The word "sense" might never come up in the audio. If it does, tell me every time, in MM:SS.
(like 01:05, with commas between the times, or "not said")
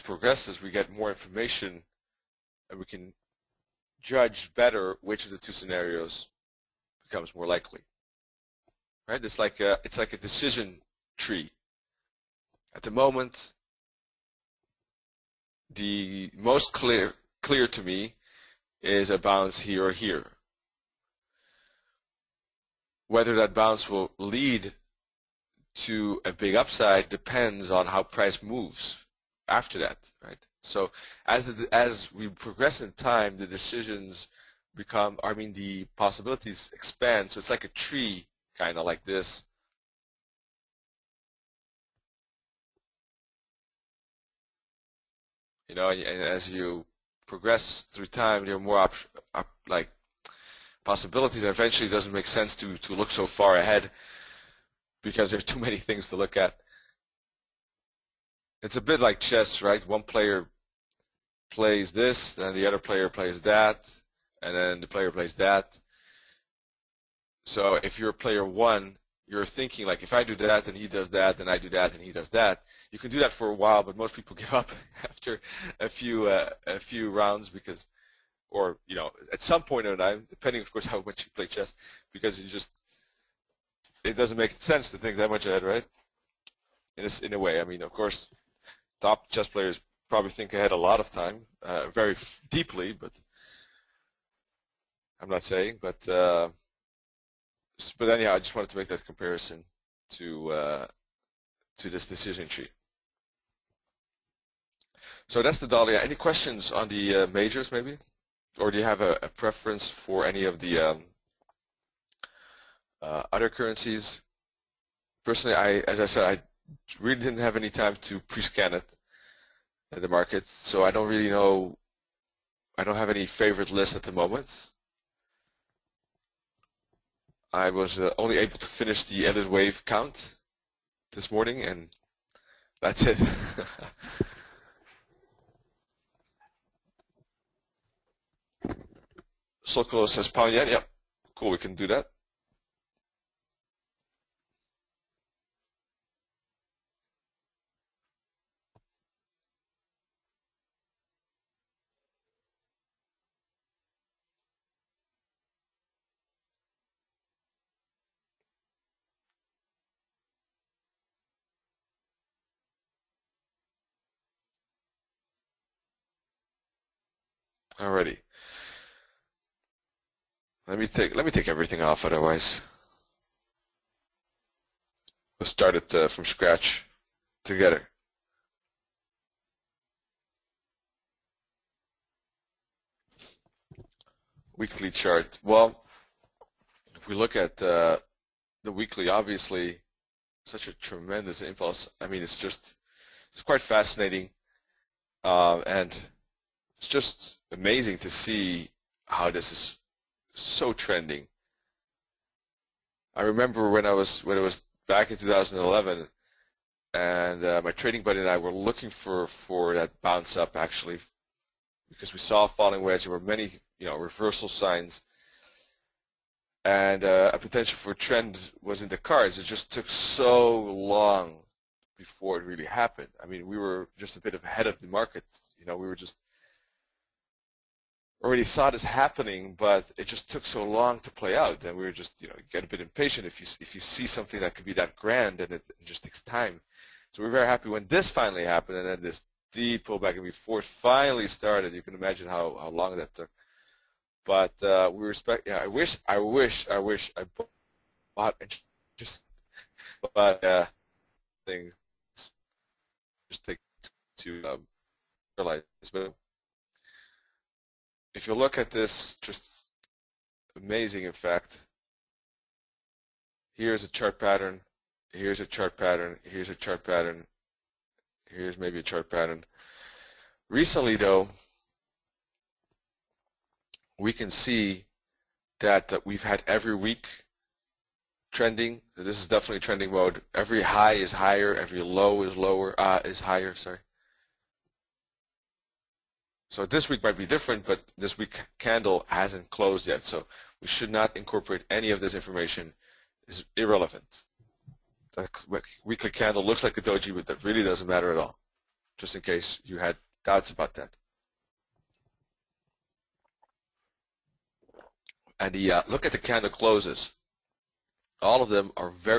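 00:52, 01:24.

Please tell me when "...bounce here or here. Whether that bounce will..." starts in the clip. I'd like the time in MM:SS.
00:19.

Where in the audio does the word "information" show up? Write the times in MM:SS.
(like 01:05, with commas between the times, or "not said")
00:01, 04:52.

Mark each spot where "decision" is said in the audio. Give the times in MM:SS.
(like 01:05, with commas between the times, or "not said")
00:10, 00:33, 01:42.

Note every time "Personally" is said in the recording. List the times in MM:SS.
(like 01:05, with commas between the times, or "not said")
01:55.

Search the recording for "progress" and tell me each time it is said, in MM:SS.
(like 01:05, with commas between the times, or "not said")
00:32, 00:47.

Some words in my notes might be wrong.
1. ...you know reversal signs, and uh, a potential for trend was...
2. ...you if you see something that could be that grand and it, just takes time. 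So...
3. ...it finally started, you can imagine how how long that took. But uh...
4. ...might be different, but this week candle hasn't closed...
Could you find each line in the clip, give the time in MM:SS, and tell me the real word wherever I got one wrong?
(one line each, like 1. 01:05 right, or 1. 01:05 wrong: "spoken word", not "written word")
1. 03:33 right
2. 03:53 right
3. 04:00 right
4. 04:47 right.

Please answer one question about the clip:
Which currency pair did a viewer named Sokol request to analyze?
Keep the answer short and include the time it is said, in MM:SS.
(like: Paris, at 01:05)
Pound yen, at 02:20.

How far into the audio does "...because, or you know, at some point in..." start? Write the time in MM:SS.
01:17.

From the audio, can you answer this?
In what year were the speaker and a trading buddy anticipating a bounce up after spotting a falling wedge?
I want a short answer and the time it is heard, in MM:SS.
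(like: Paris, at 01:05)
2011, at 03:25.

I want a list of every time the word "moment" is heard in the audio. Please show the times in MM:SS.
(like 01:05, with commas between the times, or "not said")
00:12, 02:04.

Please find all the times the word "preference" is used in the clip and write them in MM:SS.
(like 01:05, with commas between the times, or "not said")
01:49.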